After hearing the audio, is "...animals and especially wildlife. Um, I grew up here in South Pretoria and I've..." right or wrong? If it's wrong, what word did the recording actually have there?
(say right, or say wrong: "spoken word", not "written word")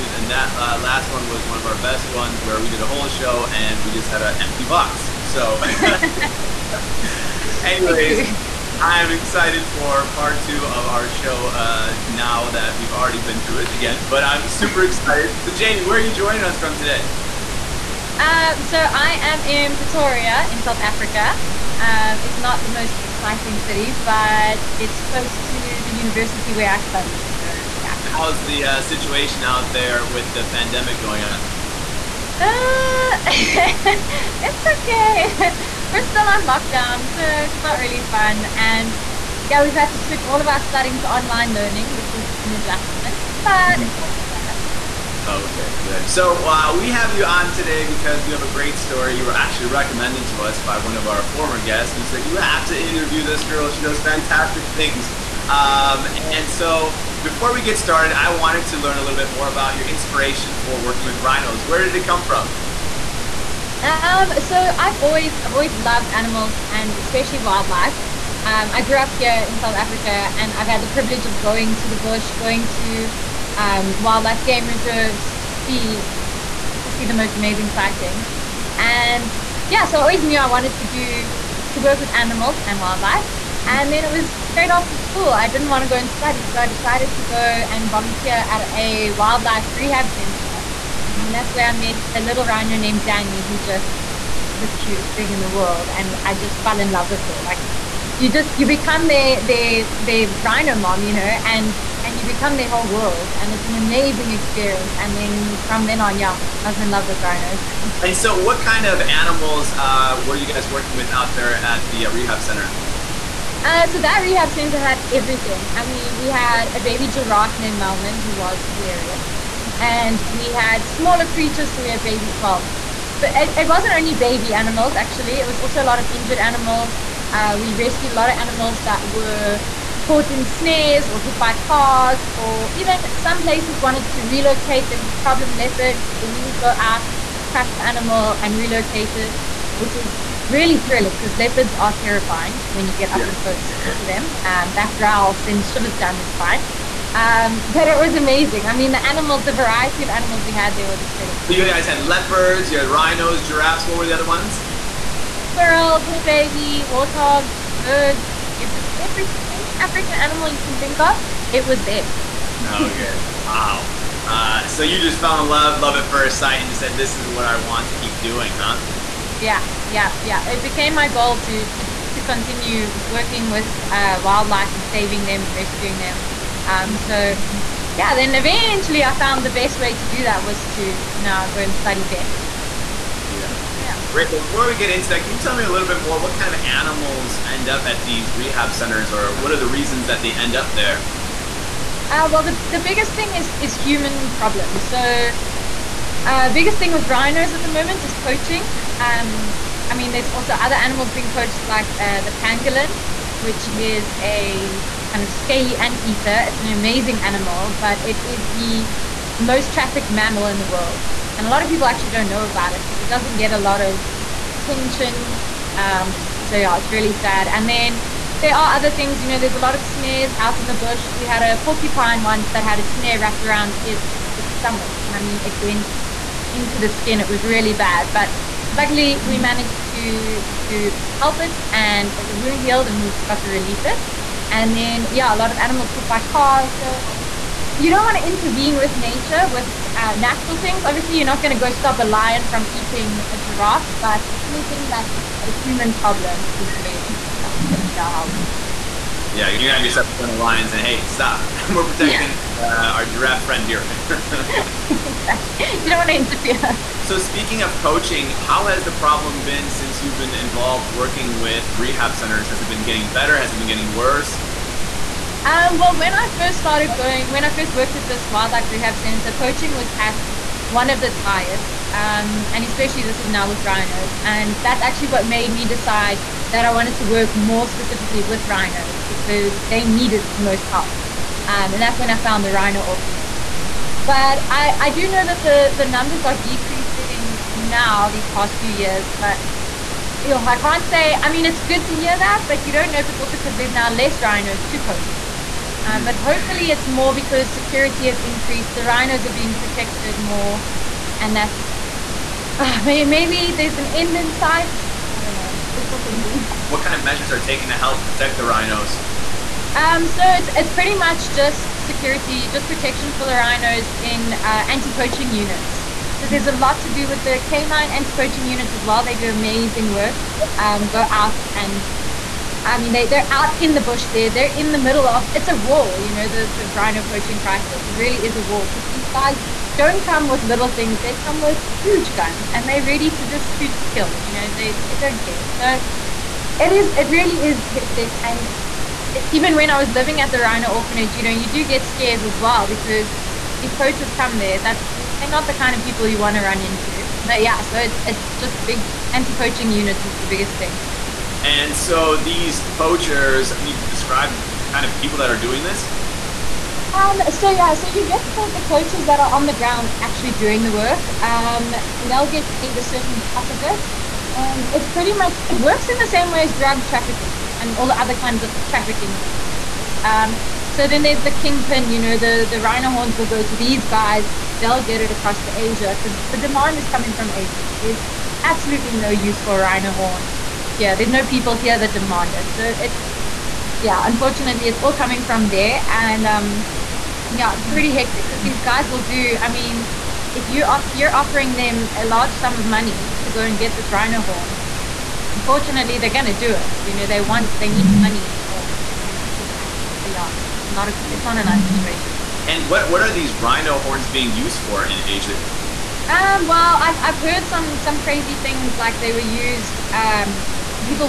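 wrong: "Africa", not "Pretoria".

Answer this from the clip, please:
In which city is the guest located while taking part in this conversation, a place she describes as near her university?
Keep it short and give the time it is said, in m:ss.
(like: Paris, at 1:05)
Pretoria, at 0:19.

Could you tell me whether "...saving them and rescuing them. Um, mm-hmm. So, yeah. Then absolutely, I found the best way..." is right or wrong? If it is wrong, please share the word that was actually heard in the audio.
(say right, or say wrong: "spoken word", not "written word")
wrong: "eventually", not "absolutely".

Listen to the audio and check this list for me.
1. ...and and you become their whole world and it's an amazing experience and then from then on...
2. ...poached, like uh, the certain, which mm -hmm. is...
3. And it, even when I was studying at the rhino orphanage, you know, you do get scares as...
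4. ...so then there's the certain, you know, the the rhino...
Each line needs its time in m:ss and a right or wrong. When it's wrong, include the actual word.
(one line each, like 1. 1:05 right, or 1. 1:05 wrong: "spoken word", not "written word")
1. 1:41 right
2. 3:21 wrong: "pangolin", not "certain"
3. 5:38 wrong: "living", not "studying"
4. 6:10 wrong: "kingpin", not "certain".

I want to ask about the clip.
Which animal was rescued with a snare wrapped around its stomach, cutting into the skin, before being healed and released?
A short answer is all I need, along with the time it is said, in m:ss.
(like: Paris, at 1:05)
Porcupine, at 3:41.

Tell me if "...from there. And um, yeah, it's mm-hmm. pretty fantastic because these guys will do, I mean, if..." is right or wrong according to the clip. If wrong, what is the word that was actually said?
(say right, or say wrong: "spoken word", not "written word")
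wrong: "hectic", not "fantastic".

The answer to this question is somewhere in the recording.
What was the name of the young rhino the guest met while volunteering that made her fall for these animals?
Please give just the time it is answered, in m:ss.
1:33.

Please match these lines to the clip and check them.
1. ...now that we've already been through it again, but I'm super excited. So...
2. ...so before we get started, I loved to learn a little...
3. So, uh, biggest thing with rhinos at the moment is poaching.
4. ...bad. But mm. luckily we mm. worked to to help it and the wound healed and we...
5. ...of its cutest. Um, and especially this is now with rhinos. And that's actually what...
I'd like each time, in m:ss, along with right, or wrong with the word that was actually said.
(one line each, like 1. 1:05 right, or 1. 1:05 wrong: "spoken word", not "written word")
1. 0:12 right
2. 0:56 wrong: "wanted", not "loved"
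3. 3:14 right
4. 3:47 wrong: "managed", not "worked"
5. 4:30 wrong: "highest", not "cutest".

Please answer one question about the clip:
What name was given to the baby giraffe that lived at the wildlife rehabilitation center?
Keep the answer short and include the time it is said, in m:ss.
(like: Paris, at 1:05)
Malman, at 1:57.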